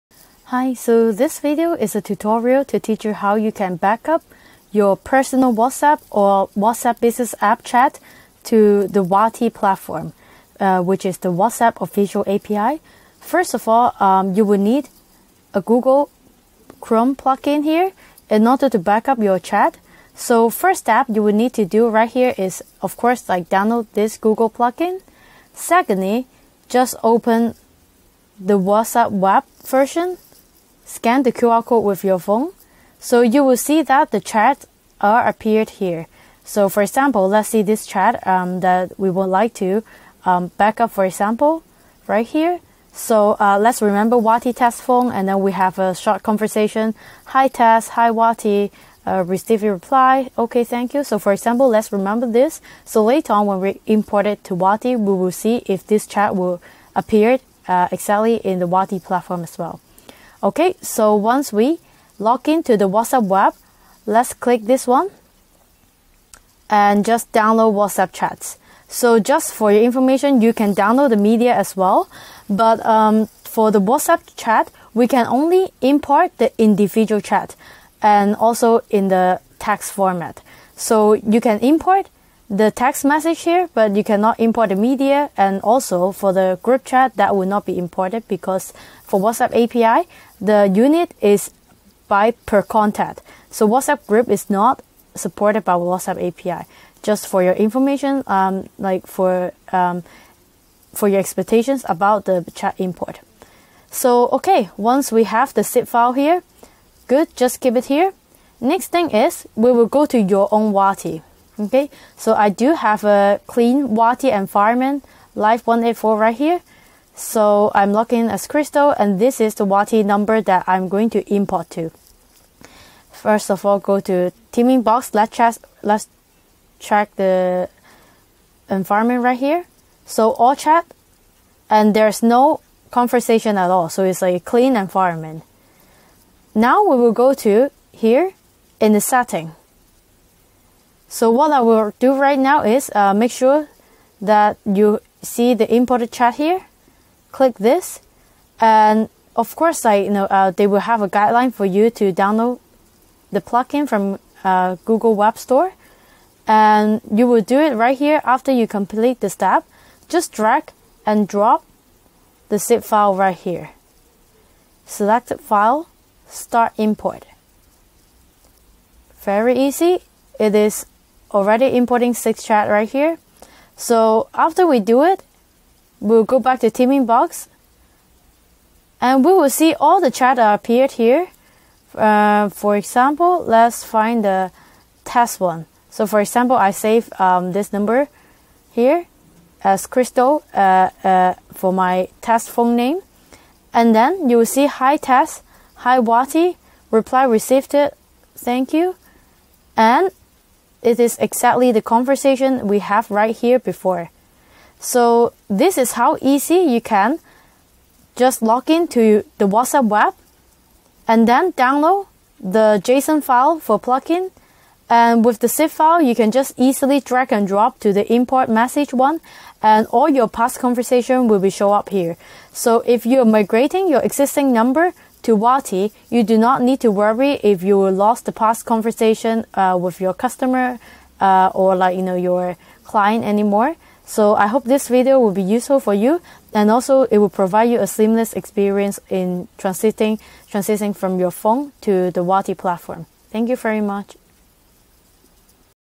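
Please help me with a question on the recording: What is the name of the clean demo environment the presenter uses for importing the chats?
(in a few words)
Live 184.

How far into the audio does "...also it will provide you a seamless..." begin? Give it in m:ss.
3:56.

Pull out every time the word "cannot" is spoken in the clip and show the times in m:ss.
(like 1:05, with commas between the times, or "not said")
1:24.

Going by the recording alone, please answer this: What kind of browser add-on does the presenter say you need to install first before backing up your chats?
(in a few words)
Google Chrome plugin.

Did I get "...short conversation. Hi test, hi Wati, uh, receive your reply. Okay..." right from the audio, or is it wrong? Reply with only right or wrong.
right.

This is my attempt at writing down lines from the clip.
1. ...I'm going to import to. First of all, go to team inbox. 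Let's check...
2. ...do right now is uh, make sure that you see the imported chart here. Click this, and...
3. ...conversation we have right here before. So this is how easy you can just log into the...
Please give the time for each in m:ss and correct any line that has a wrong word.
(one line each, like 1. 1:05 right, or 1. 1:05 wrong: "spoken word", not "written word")
1. 2:00 right
2. 2:21 right
3. 3:21 right.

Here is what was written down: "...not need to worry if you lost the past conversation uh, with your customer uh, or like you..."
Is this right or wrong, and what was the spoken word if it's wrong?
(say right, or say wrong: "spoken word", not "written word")
right.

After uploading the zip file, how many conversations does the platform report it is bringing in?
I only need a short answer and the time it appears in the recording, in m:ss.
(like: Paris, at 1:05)
6, at 2:52.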